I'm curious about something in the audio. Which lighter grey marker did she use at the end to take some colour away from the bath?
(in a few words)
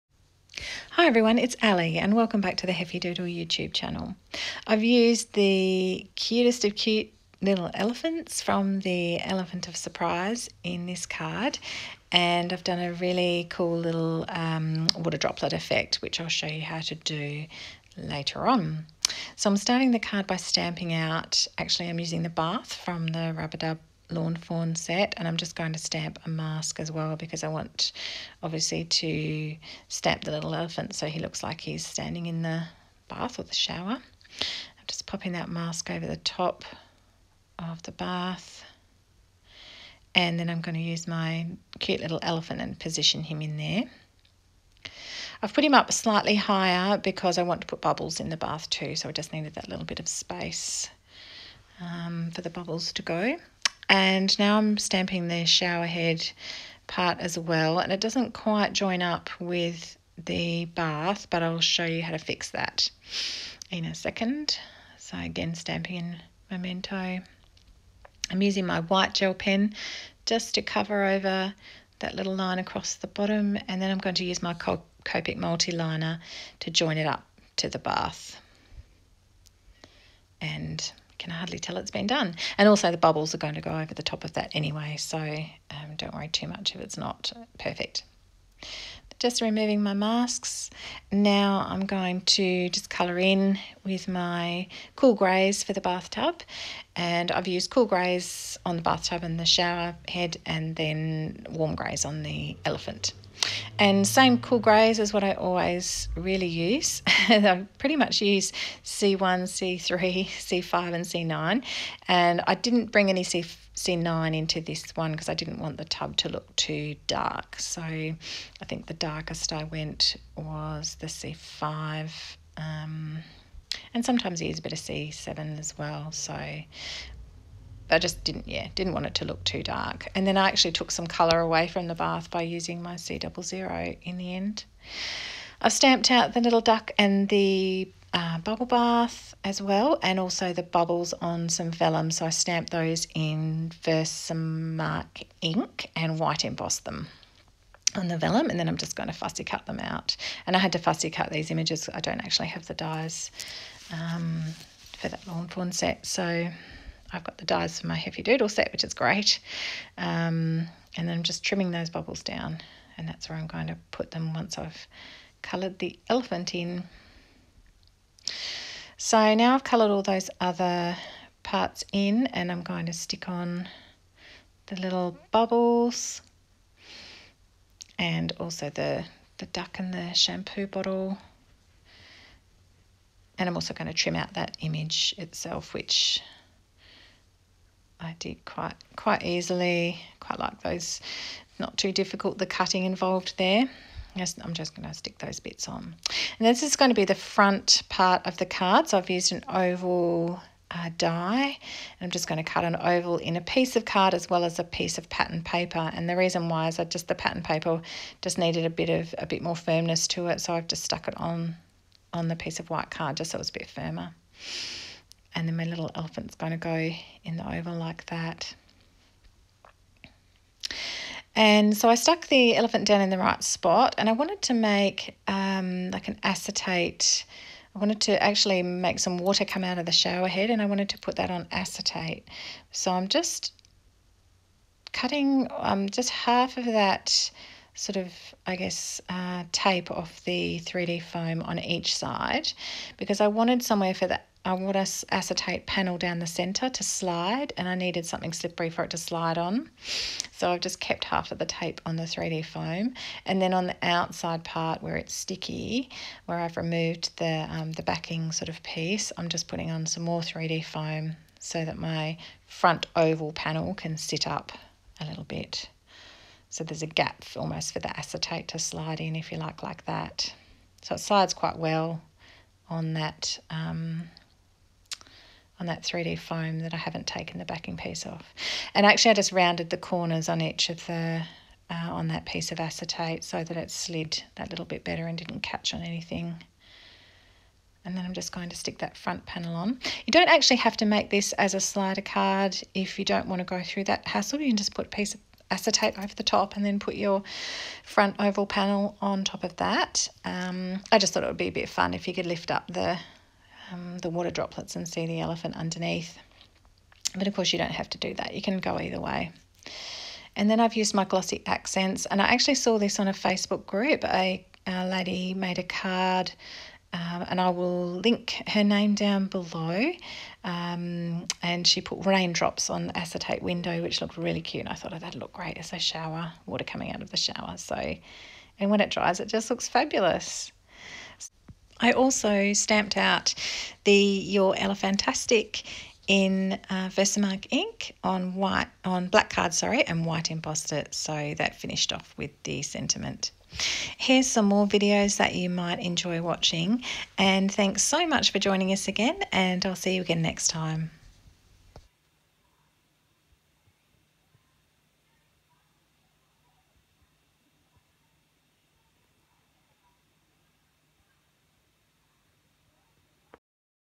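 C00.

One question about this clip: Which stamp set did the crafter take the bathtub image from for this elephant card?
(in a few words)
Rub-a-Dub.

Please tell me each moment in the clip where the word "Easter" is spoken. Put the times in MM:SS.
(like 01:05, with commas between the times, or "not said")
not said.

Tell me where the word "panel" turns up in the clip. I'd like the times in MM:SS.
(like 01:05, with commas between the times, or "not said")
04:05, 04:23, 04:49, 04:58.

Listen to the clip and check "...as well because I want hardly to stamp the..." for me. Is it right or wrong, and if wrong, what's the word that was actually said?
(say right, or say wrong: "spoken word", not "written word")
wrong: "obviously", not "hardly".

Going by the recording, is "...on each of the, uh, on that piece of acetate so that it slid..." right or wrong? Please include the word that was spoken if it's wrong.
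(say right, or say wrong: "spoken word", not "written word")
right.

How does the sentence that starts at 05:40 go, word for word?
So that finished off with the sentiment.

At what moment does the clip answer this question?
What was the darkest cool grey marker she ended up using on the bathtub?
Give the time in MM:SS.
02:00.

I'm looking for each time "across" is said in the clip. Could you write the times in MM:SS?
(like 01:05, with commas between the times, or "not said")
01:12.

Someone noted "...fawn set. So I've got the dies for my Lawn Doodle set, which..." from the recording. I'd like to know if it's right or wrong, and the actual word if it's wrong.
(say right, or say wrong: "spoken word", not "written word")
wrong: "Heffy", not "Lawn".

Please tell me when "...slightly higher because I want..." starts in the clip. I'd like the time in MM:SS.
00:45.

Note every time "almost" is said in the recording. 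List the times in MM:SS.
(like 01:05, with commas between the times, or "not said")
04:27.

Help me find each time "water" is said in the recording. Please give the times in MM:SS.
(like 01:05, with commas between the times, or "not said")
00:14, 03:49, 05:04, 05:26.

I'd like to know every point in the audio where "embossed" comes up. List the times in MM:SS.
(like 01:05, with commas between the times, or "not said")
02:26, 05:40.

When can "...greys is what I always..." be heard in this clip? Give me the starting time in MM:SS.
01:44.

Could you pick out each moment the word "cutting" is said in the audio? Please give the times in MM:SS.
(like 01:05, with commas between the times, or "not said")
03:12, 03:54.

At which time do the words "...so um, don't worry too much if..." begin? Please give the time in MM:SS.
01:24.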